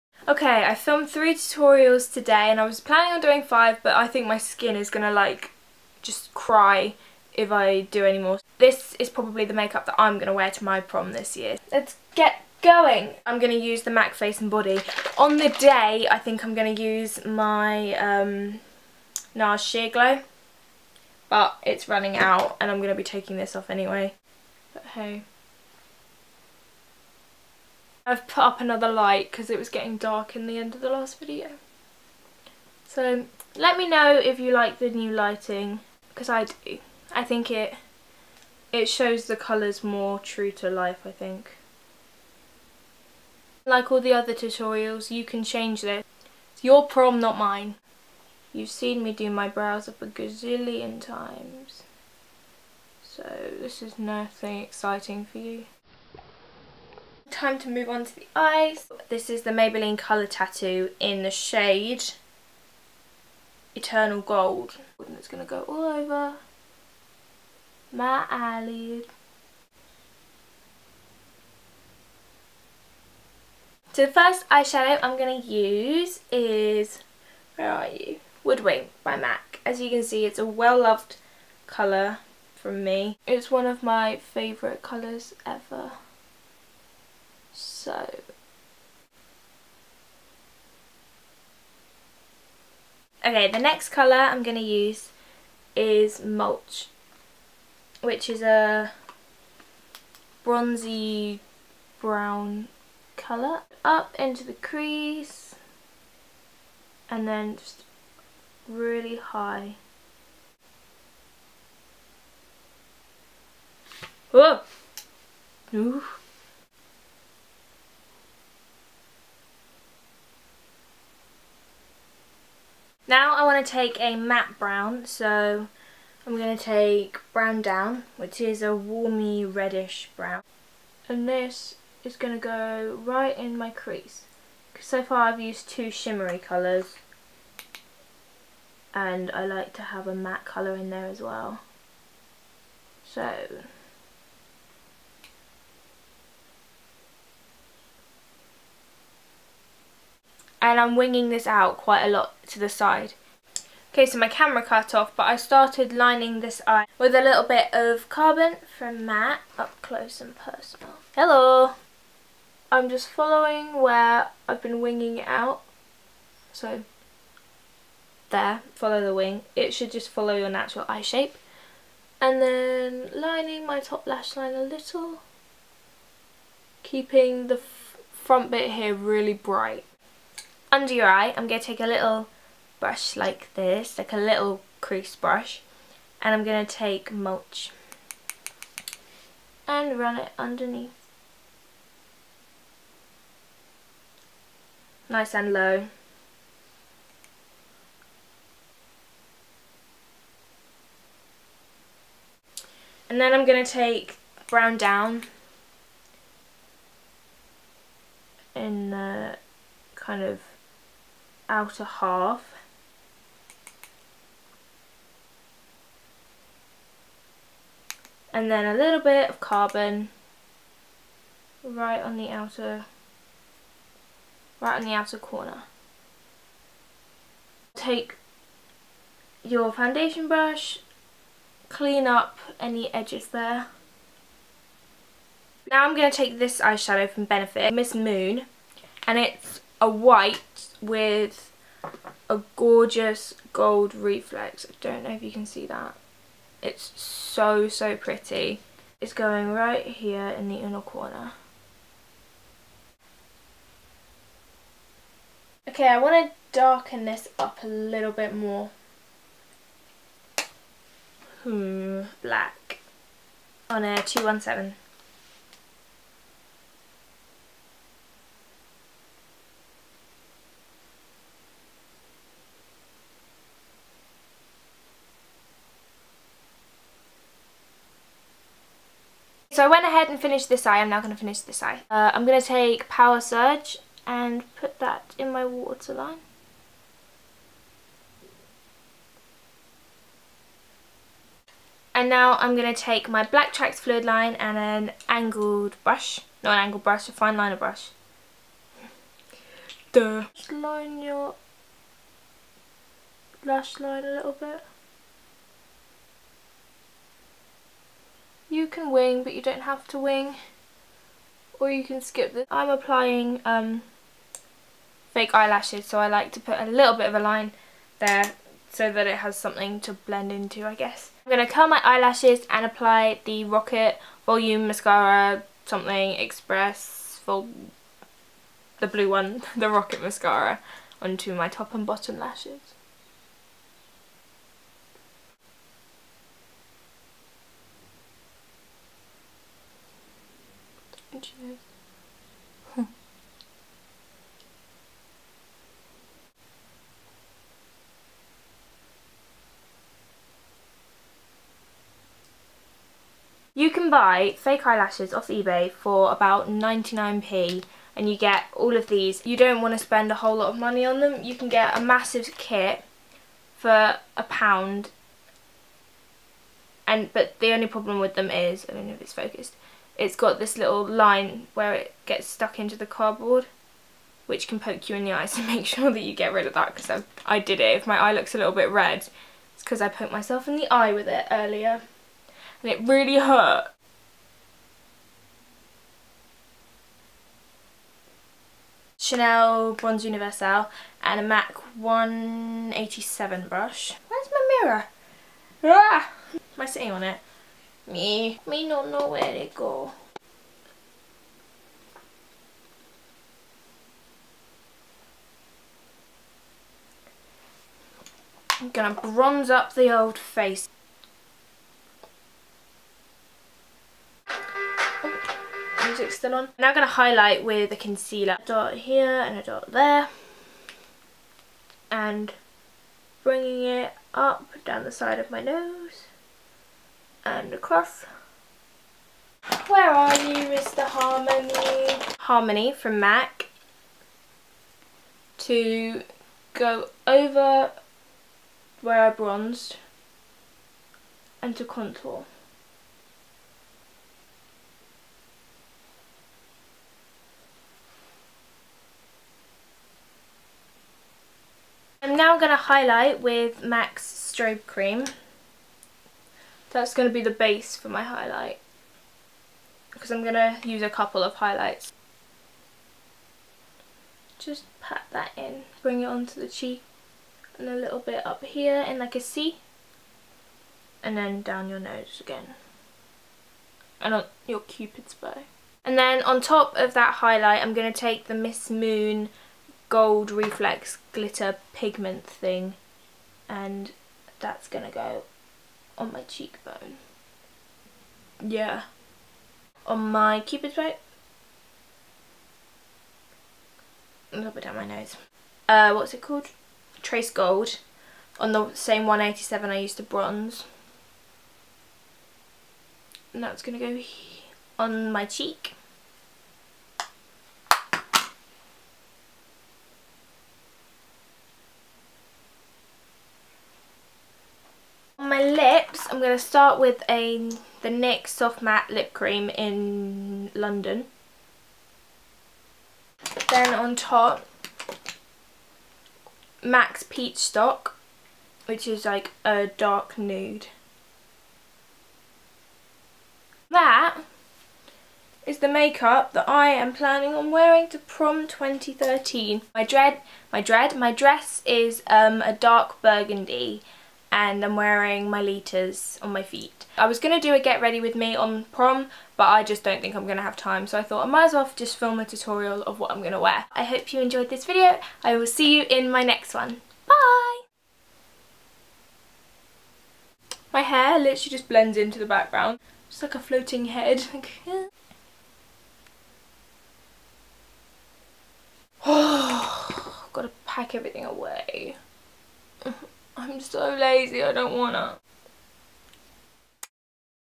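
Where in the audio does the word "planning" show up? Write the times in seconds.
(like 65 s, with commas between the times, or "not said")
2 s, 536 s.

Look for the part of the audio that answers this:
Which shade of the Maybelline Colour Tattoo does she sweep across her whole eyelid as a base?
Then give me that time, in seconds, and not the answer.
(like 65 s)
63 s.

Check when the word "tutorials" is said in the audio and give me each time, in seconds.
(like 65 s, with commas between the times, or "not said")
1 s, 44 s, 552 s.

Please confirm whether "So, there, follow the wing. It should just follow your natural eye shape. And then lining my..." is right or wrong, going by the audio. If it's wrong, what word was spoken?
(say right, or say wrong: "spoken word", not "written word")
right.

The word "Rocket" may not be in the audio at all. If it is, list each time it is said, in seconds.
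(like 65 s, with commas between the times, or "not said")
323 s, 329 s.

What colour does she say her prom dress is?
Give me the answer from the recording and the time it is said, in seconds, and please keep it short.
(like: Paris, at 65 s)
dark burgundy, at 542 s.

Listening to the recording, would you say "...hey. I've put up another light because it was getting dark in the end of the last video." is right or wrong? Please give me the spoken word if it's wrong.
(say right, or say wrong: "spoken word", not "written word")
right.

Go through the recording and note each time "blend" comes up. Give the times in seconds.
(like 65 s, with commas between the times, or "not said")
319 s, 561 s.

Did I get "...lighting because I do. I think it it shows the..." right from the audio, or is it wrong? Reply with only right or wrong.
right.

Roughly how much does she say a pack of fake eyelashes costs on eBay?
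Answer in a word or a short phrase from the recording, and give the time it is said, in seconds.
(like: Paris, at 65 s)
99p, at 356 s.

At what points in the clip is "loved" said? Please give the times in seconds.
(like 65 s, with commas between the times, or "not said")
80 s.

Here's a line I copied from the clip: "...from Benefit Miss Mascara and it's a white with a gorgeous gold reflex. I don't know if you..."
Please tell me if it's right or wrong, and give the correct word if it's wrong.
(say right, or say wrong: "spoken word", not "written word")
wrong: "Moon", not "Mascara".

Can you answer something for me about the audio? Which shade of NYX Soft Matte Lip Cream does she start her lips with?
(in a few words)
London.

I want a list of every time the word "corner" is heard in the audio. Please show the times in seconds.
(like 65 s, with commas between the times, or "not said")
225 s, 250 s.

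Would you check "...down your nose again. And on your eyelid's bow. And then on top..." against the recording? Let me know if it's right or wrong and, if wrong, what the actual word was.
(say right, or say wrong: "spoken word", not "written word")
wrong: "cupid", not "eyelid".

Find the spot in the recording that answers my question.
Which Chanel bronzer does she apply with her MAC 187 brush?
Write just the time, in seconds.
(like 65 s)
389 s.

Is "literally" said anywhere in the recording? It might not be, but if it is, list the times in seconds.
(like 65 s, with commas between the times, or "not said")
561 s.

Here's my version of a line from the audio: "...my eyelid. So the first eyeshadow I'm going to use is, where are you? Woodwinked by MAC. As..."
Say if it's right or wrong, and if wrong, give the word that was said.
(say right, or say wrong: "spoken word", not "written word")
right.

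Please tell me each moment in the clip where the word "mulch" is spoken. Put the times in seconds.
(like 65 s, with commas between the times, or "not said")
96 s, 187 s.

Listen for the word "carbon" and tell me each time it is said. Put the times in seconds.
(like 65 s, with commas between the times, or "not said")
158 s, 219 s.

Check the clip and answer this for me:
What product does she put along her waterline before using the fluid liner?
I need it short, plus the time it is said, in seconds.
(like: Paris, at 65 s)
Power Surge, at 282 s.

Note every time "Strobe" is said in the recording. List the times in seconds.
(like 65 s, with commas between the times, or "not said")
453 s.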